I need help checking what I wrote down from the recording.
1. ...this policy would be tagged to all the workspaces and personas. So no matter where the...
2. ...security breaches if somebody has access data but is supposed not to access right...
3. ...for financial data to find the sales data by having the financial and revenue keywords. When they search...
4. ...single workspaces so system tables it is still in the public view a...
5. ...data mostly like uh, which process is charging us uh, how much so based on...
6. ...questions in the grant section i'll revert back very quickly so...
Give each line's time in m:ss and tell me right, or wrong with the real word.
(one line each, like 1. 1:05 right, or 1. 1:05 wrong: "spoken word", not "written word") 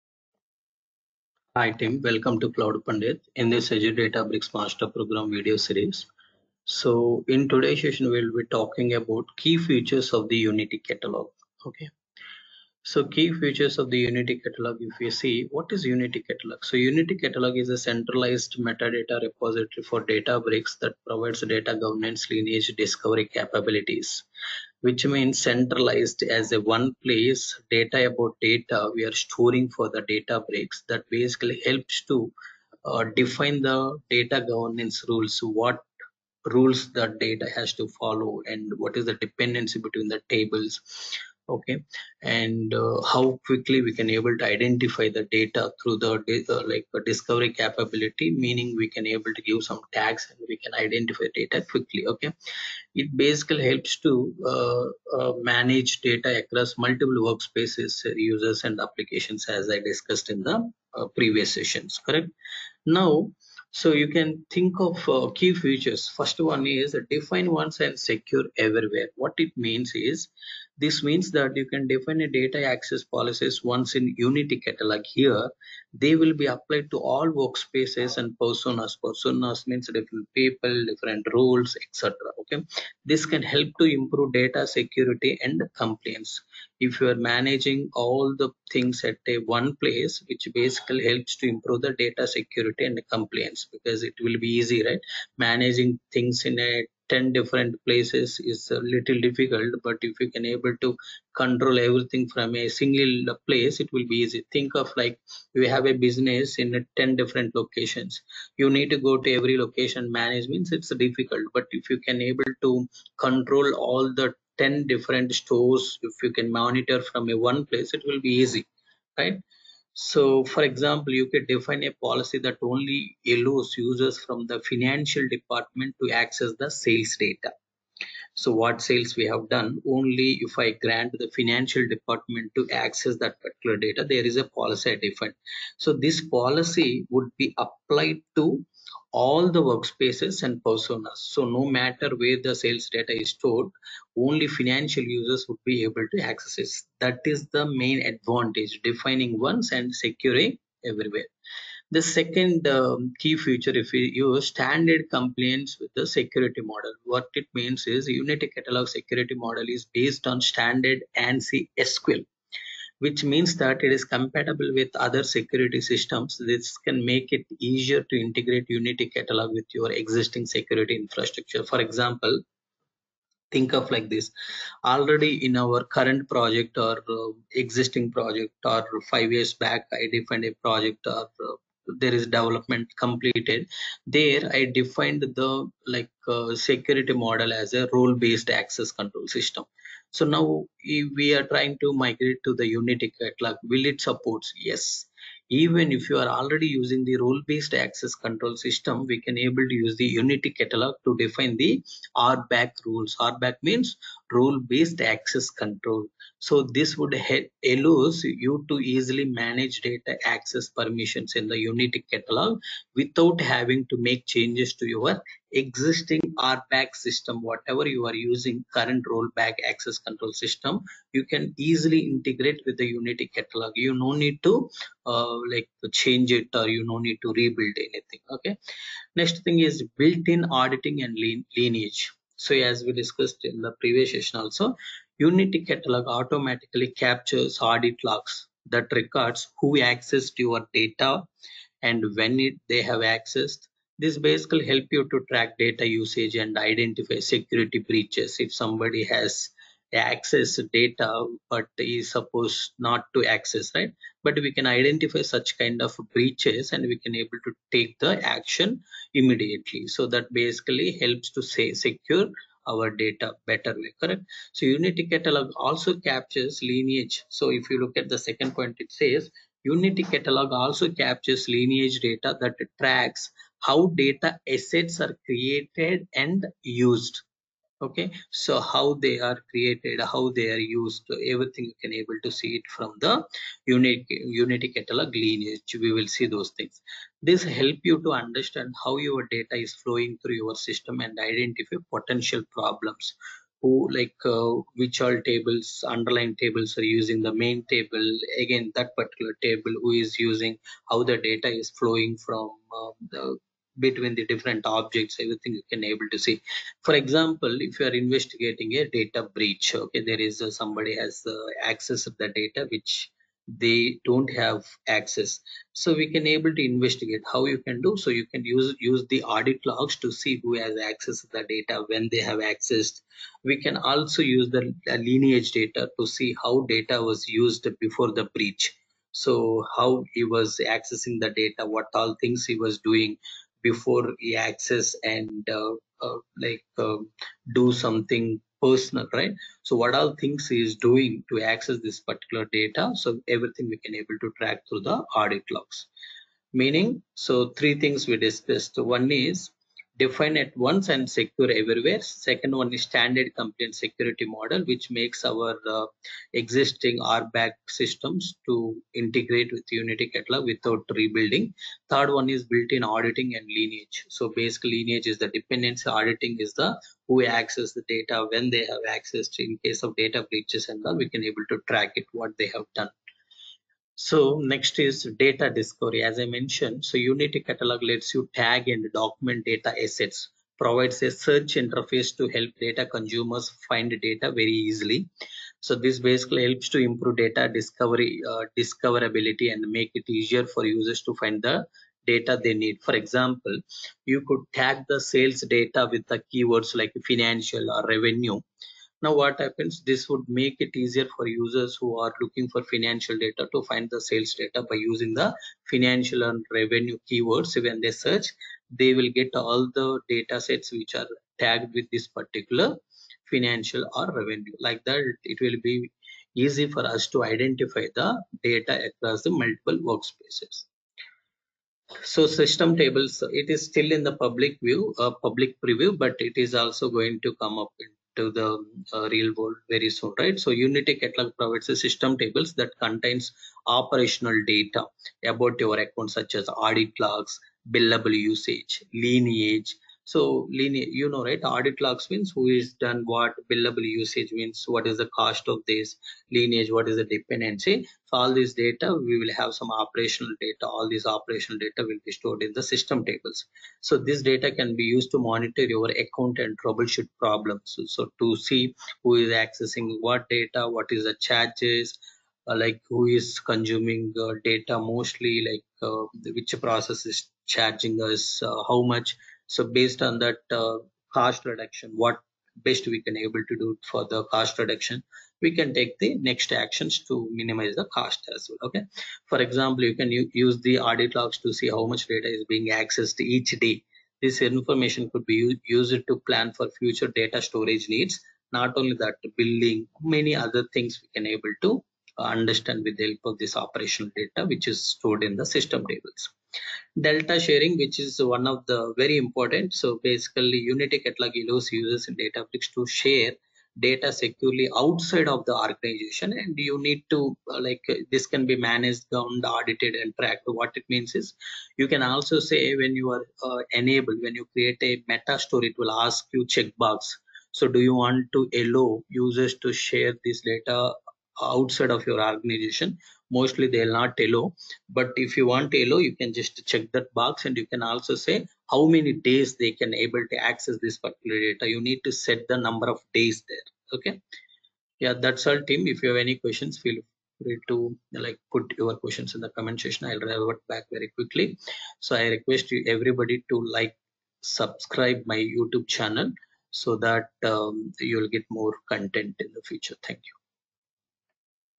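1. 2:16 wrong: "applied", not "tagged"
2. 4:07 right
3. 6:42 wrong: "using", not "having"
4. 6:59 wrong: "multiple", not "single"
5. 7:44 right
6. 8:58 wrong: "comment", not "grant".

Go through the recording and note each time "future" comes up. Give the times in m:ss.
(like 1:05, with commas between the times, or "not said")
8:06, 9:09.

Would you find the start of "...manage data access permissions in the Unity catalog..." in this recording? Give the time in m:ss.
3:29.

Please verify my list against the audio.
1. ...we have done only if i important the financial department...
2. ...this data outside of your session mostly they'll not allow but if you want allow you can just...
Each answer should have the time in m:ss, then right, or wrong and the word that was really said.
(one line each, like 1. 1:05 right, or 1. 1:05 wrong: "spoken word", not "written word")
1. 2:09 wrong: "grant", not "important"
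2. 8:40 wrong: "organization", not "session".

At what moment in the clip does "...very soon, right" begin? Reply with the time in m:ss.
7:09.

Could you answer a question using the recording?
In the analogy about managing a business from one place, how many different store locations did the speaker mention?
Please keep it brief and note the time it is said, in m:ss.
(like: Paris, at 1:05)
10, at 1:47.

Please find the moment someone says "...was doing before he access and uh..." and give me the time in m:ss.
5:32.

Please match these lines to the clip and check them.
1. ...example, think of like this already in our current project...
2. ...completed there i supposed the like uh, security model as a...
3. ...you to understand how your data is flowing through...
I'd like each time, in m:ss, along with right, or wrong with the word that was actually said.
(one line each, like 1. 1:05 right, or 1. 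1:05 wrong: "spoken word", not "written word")
1. 2:51 right
2. 3:02 wrong: "defined", not "supposed"
3. 4:47 right.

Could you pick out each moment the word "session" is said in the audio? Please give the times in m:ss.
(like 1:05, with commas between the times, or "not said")
0:07, 1:01, 3:54.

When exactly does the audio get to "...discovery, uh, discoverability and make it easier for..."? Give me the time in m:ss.
6:27.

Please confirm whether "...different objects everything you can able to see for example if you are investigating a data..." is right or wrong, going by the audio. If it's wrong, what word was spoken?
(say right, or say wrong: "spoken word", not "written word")
right.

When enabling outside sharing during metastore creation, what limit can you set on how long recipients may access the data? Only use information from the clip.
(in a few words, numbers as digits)
Number of days.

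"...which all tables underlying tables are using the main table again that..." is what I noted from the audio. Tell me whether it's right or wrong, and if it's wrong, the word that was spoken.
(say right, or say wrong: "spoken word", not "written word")
right.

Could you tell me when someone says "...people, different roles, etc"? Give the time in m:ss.
1:20.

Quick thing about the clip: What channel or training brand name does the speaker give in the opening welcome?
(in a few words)
Cloud Pandith.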